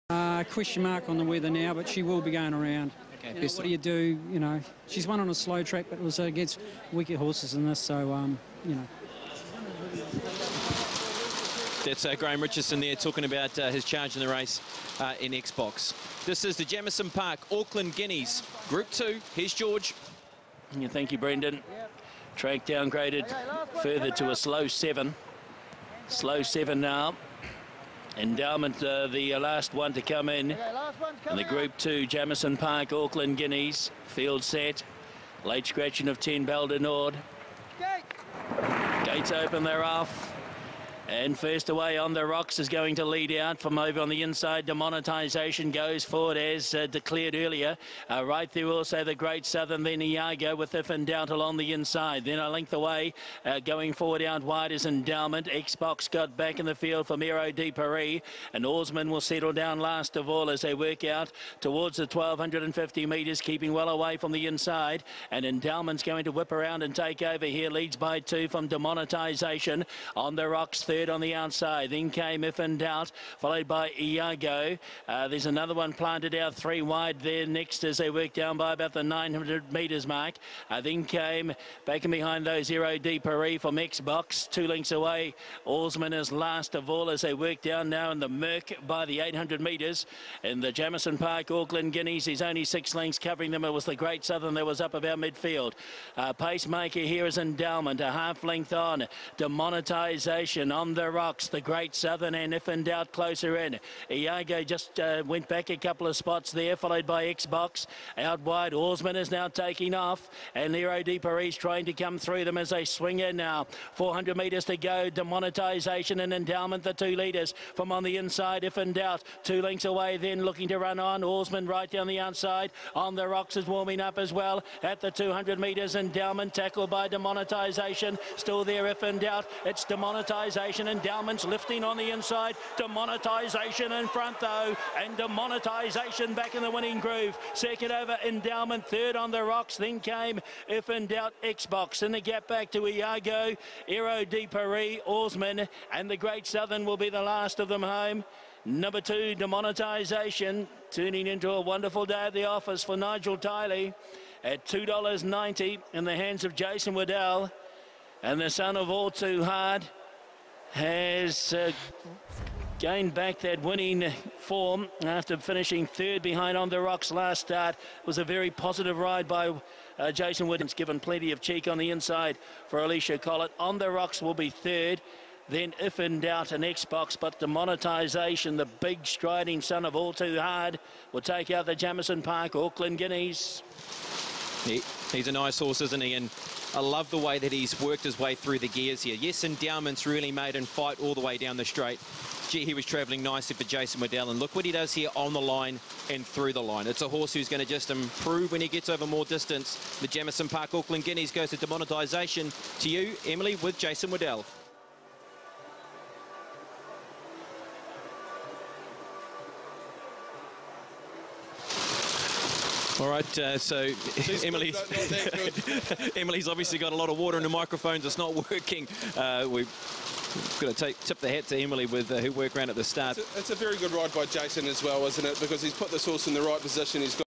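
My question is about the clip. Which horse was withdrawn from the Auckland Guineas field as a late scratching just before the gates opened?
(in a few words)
Balder Nord.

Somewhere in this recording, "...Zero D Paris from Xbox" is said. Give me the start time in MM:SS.
01:22.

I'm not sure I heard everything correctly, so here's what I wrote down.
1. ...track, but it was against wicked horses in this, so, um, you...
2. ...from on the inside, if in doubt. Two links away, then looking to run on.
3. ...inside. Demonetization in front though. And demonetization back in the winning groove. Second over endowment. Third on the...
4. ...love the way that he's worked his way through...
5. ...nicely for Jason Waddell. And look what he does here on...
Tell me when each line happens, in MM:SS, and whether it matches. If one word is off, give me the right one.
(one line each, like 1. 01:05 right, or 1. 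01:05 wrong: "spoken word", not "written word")
1. 00:05 right
2. 01:57 right
3. 02:12 right
4. 03:06 right
5. 03:13 right.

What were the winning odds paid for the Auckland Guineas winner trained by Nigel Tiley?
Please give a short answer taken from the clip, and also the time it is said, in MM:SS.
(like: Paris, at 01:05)
$2.90, at 02:34.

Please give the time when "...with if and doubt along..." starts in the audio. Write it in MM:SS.
00:50.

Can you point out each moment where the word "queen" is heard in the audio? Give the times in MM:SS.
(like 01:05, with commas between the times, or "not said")
not said.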